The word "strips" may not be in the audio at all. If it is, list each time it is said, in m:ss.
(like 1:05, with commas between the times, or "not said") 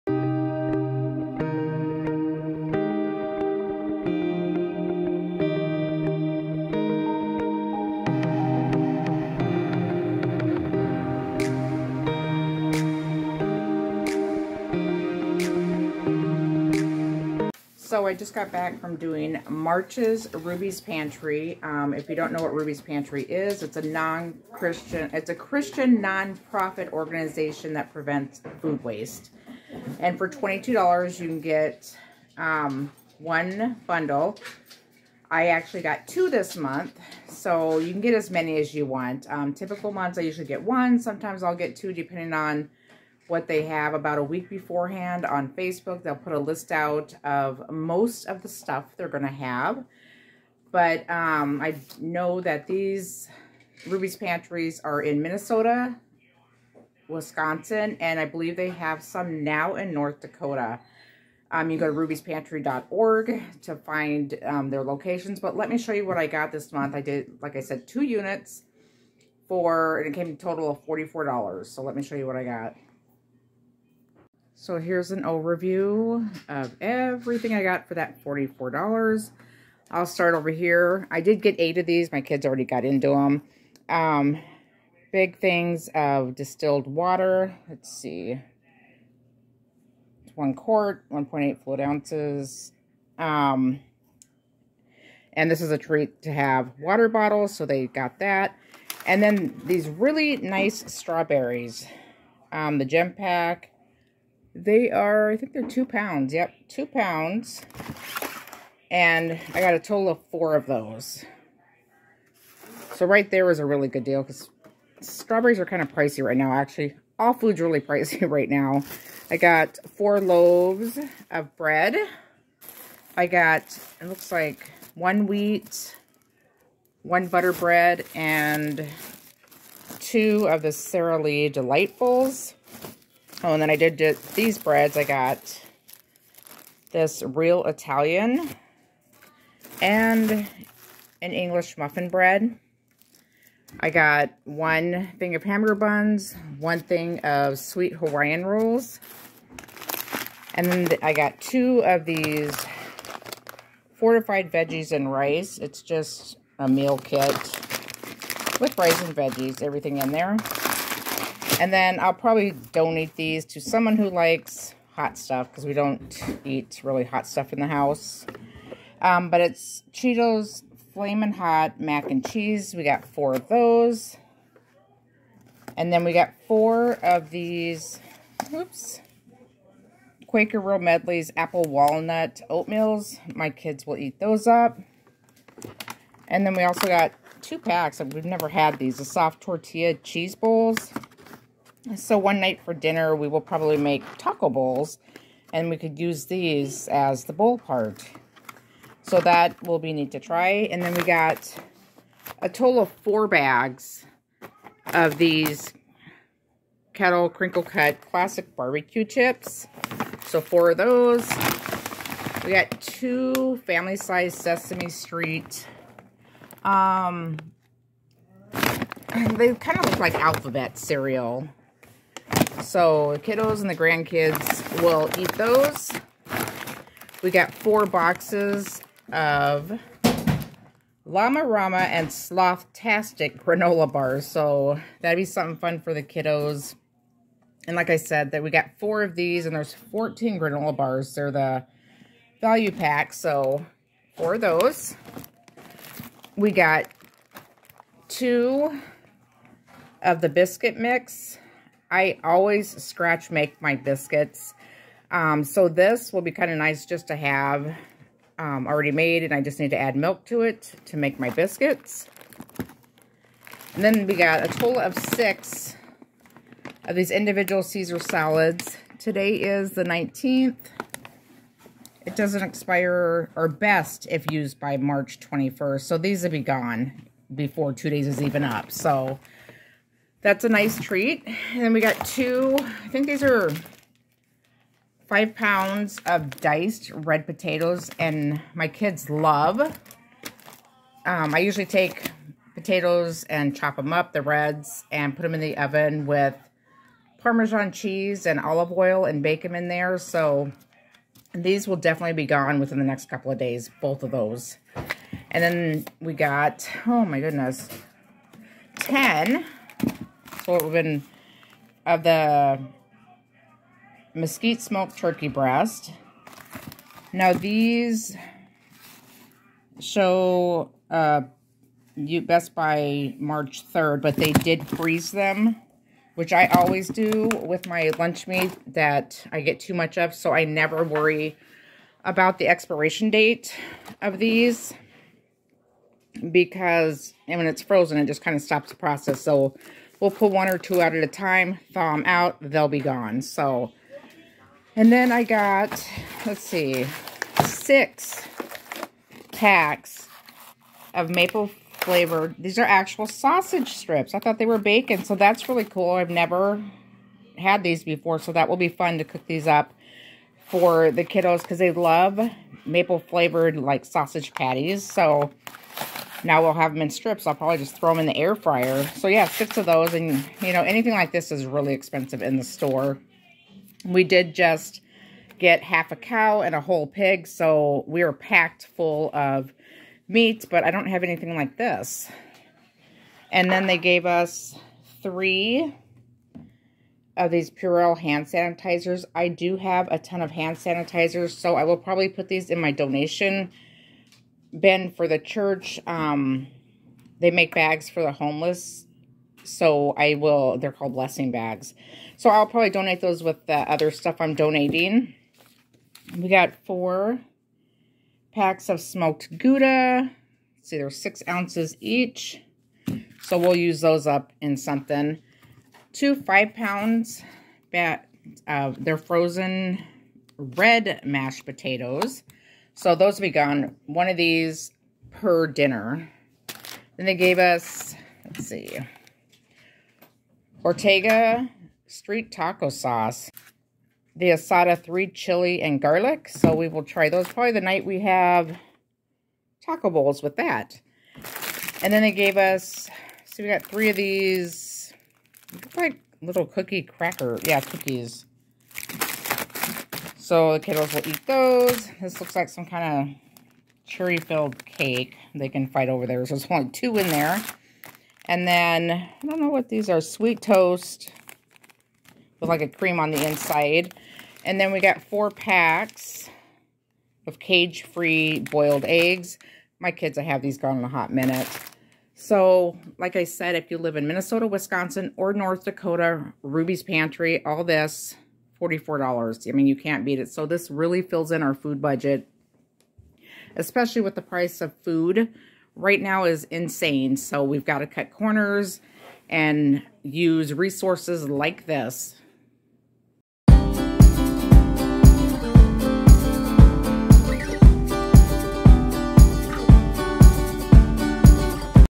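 5:53, 6:06.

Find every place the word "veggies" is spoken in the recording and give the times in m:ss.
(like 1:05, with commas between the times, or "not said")
2:34, 2:39.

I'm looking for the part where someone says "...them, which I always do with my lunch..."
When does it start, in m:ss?
5:25.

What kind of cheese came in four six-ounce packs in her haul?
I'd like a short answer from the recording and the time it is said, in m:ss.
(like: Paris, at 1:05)
smoked Gouda, at 6:48.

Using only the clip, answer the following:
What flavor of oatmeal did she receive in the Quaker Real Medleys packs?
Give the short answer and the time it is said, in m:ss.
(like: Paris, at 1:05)
Apple Walnut, at 3:01.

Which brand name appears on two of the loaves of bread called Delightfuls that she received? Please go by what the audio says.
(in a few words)
Sara Lee.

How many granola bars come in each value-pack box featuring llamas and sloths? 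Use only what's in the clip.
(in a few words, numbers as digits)
14.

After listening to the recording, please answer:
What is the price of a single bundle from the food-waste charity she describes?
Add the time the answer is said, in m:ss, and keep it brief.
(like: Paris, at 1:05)
$22, at 0:30.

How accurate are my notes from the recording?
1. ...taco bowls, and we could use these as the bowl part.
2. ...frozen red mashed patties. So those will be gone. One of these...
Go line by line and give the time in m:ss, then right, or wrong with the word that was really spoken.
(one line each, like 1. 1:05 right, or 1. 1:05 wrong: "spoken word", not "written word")
1. 3:14 right
2. 6:58 wrong: "potatoes", not "patties".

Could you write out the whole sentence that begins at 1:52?
So right there was a really good deal because strawberries are kind of pricey right now, actually.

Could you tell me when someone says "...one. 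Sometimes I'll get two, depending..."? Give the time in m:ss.
0:40.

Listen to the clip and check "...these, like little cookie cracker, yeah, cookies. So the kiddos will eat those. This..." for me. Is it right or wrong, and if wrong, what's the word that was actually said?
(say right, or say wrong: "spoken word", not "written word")
right.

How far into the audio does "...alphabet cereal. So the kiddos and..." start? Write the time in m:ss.
3:40.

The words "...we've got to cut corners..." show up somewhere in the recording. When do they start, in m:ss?
8:07.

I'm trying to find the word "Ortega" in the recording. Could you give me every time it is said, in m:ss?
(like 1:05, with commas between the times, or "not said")
7:10.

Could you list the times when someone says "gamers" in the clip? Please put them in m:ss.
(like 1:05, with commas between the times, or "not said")
not said.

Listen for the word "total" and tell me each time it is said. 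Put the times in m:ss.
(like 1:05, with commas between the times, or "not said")
1:10, 1:49, 3:22, 4:24.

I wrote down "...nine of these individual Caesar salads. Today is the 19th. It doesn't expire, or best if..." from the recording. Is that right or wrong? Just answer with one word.
wrong.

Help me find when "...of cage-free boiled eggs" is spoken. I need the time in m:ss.
7:47.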